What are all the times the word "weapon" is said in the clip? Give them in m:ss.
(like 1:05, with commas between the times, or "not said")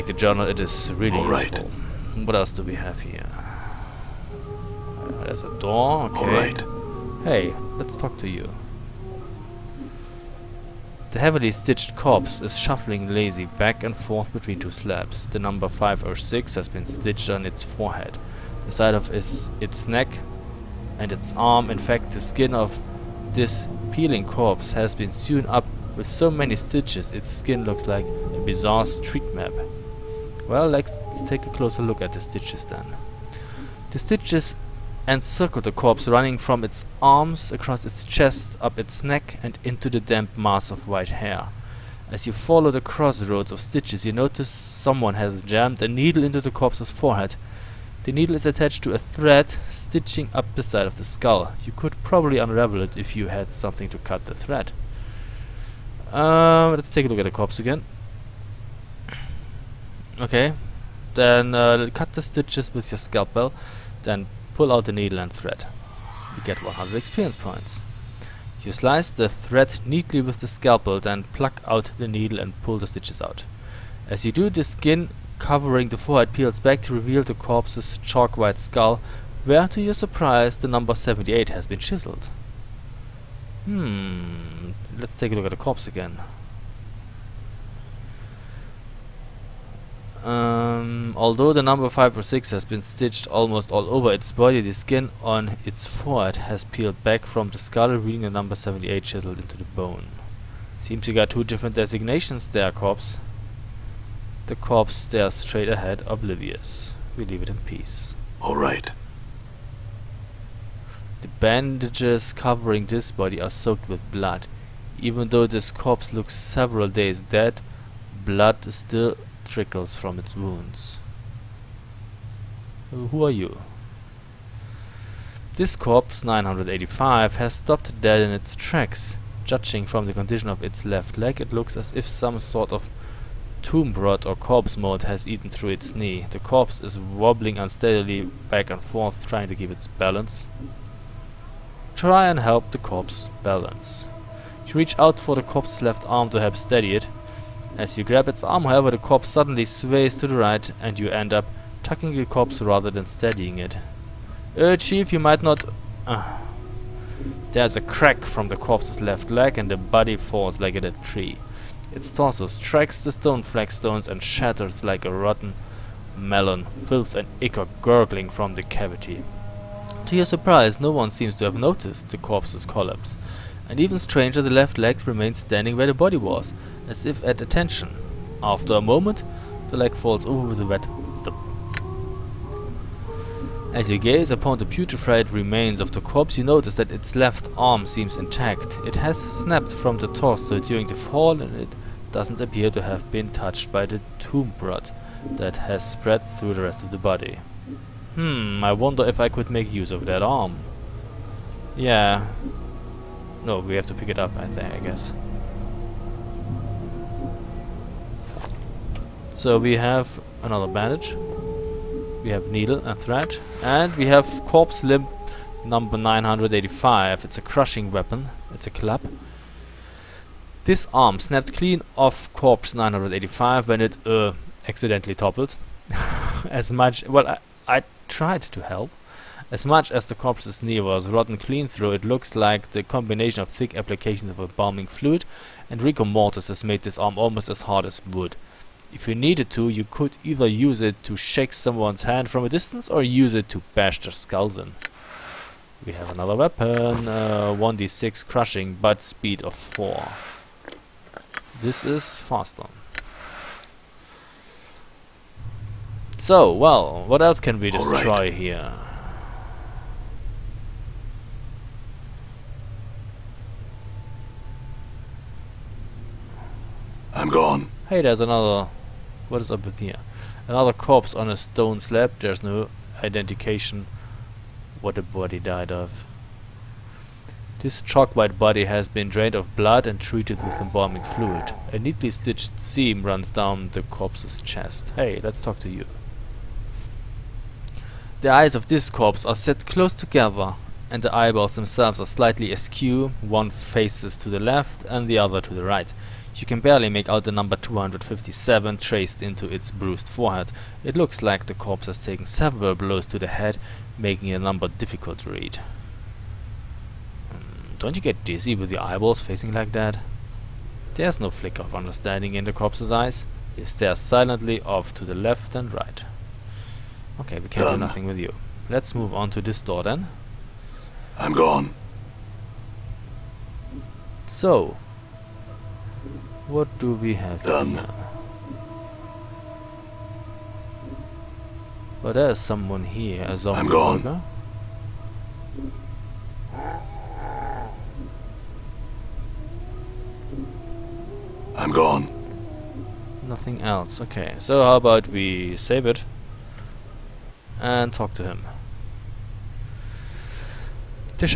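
3:37, 4:06.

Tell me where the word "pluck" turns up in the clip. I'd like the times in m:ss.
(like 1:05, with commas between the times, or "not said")
1:11.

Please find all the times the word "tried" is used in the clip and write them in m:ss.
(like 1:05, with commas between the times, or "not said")
3:48.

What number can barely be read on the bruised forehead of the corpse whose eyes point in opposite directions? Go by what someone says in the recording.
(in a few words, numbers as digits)
257.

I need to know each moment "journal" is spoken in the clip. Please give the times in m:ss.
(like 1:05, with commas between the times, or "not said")
0:00.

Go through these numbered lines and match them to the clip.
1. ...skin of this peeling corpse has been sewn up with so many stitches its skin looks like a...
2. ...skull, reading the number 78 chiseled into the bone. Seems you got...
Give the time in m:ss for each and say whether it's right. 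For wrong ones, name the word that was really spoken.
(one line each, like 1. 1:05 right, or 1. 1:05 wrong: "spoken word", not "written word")
1. 0:22 right
2. 1:37 right.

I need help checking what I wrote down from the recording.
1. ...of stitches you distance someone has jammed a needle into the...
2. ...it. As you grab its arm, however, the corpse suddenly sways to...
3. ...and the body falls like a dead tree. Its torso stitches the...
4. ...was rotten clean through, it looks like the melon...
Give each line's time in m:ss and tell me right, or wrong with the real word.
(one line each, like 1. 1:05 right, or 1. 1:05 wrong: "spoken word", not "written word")
1. 0:43 wrong: "notice", not "distance"
2. 2:26 right
3. 2:39 wrong: "strikes", not "stitches"
4. 3:50 wrong: "combination", not "melon".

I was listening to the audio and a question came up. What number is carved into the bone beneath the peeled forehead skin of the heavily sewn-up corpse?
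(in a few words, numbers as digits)
78.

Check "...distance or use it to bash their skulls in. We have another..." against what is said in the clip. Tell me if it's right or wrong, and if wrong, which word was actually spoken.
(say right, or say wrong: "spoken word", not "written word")
right.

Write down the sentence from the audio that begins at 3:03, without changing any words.
As you gaze upon the putrefied remains of the corpse, you notice that its left arm seems intact.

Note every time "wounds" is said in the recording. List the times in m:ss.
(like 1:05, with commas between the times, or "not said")
2:00.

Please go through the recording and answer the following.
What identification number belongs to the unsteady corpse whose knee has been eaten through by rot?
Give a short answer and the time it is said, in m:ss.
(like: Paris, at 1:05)
985, at 2:05.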